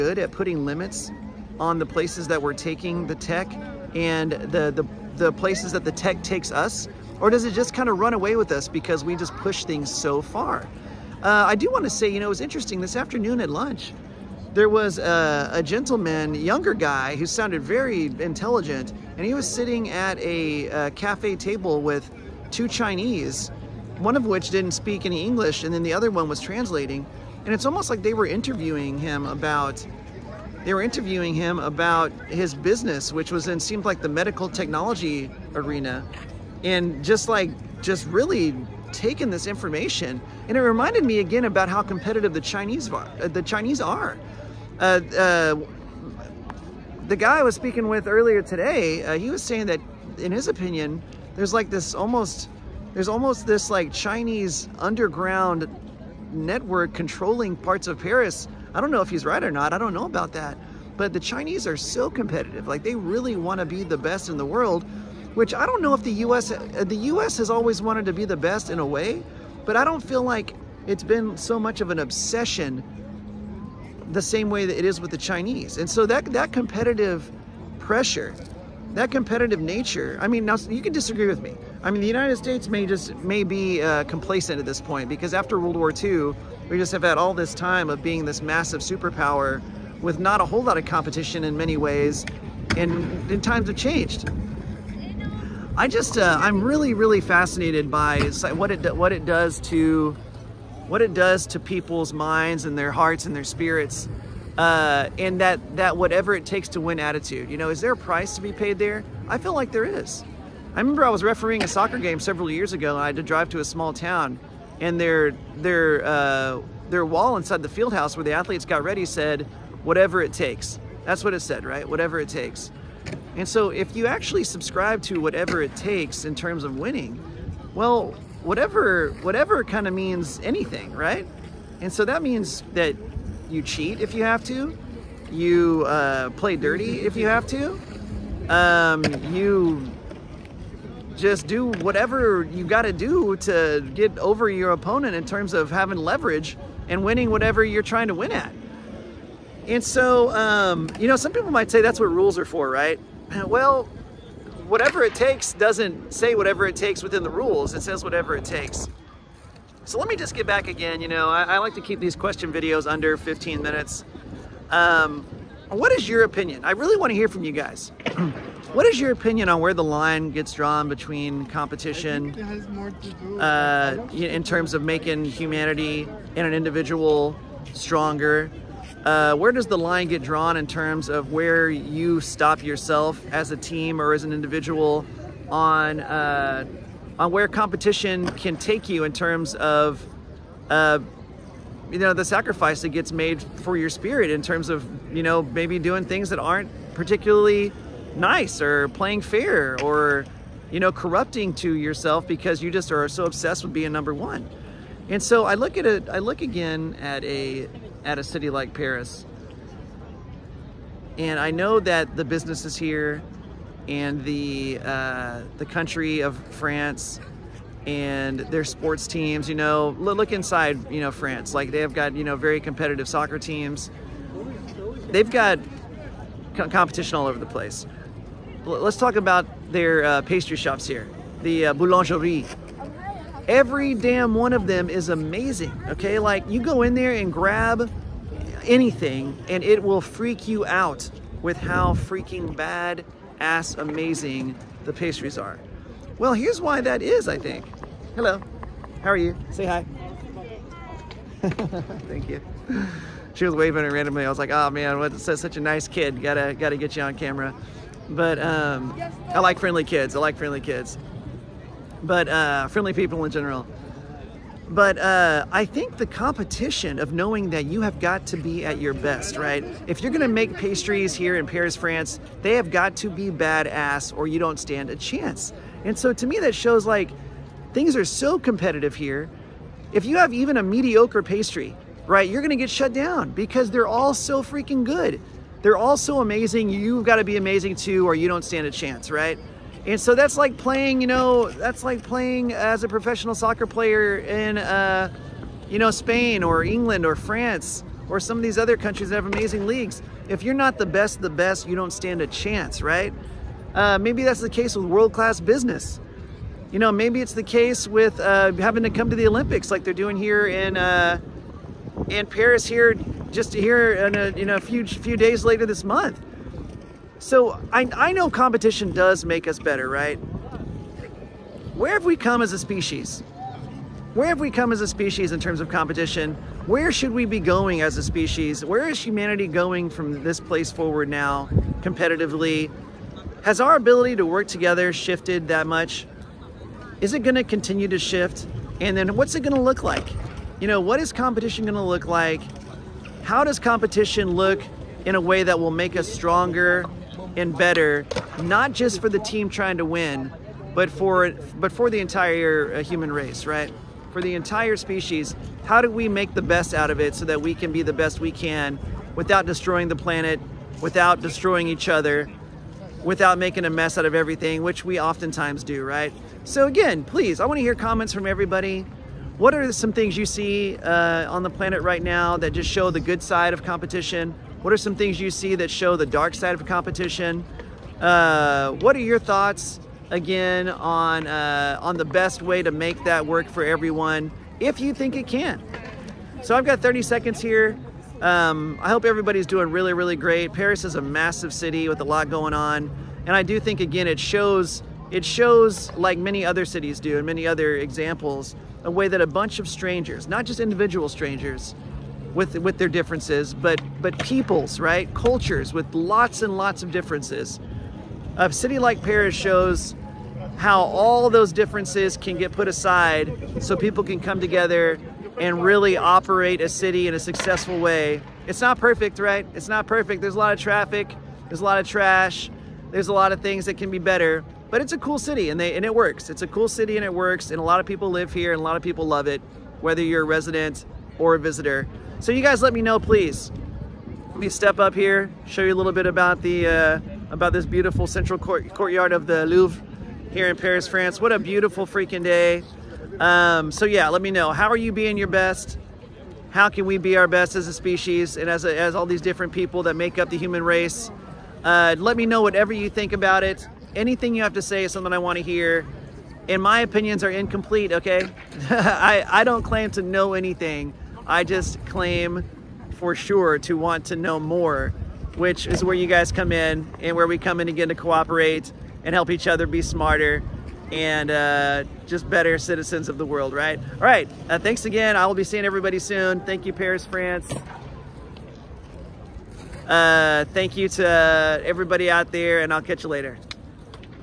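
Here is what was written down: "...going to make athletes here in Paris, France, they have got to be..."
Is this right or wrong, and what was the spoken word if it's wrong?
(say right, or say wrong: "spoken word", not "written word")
wrong: "pastries", not "athletes".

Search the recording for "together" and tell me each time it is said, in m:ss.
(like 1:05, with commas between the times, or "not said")
5:34, 6:54.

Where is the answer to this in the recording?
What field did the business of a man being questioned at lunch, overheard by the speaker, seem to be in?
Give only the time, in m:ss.
0:34.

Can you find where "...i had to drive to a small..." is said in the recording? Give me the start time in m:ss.
1:53.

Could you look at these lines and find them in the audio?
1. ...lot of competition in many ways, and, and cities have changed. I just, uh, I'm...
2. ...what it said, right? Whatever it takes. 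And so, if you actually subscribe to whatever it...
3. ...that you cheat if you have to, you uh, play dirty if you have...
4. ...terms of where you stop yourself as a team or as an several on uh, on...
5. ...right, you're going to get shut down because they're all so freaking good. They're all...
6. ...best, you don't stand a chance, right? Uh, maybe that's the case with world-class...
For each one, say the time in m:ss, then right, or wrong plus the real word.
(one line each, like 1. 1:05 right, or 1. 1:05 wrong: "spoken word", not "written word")
1. 1:30 wrong: "times", not "cities"
2. 2:01 right
3. 2:12 right
4. 3:00 wrong: "individual", not "several"
5. 4:42 right
6. 5:01 right.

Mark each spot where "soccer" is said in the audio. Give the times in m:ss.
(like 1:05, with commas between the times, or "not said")
1:51, 3:43, 4:53.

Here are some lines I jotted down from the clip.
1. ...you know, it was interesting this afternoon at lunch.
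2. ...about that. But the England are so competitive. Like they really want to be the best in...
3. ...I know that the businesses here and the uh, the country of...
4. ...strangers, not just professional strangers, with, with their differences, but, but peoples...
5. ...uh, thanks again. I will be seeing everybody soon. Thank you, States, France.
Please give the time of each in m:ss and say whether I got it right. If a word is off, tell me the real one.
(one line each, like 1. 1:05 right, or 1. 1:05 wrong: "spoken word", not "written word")
1. 0:12 right
2. 1:00 wrong: "Chinese", not "England"
3. 3:31 right
4. 6:39 wrong: "individual", not "professional"
5. 7:54 wrong: "Paris", not "States".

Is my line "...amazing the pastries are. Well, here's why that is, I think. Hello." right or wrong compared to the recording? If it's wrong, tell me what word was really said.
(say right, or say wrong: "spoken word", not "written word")
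right.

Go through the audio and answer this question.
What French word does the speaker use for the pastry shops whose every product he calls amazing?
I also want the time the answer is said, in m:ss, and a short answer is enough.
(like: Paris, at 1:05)
boulangerie, at 3:51.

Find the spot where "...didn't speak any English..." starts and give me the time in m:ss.
0:24.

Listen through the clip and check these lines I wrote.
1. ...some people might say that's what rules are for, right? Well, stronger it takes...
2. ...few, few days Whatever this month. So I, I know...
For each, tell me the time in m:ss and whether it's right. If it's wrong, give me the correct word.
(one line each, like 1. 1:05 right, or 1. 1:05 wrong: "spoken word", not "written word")
1. 2:31 wrong: "whatever", not "stronger"
2. 5:14 wrong: "later", not "Whatever".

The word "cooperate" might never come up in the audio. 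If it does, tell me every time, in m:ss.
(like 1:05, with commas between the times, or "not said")
7:47.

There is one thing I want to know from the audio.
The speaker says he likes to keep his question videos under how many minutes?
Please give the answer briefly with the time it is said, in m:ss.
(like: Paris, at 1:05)
15, at 2:43.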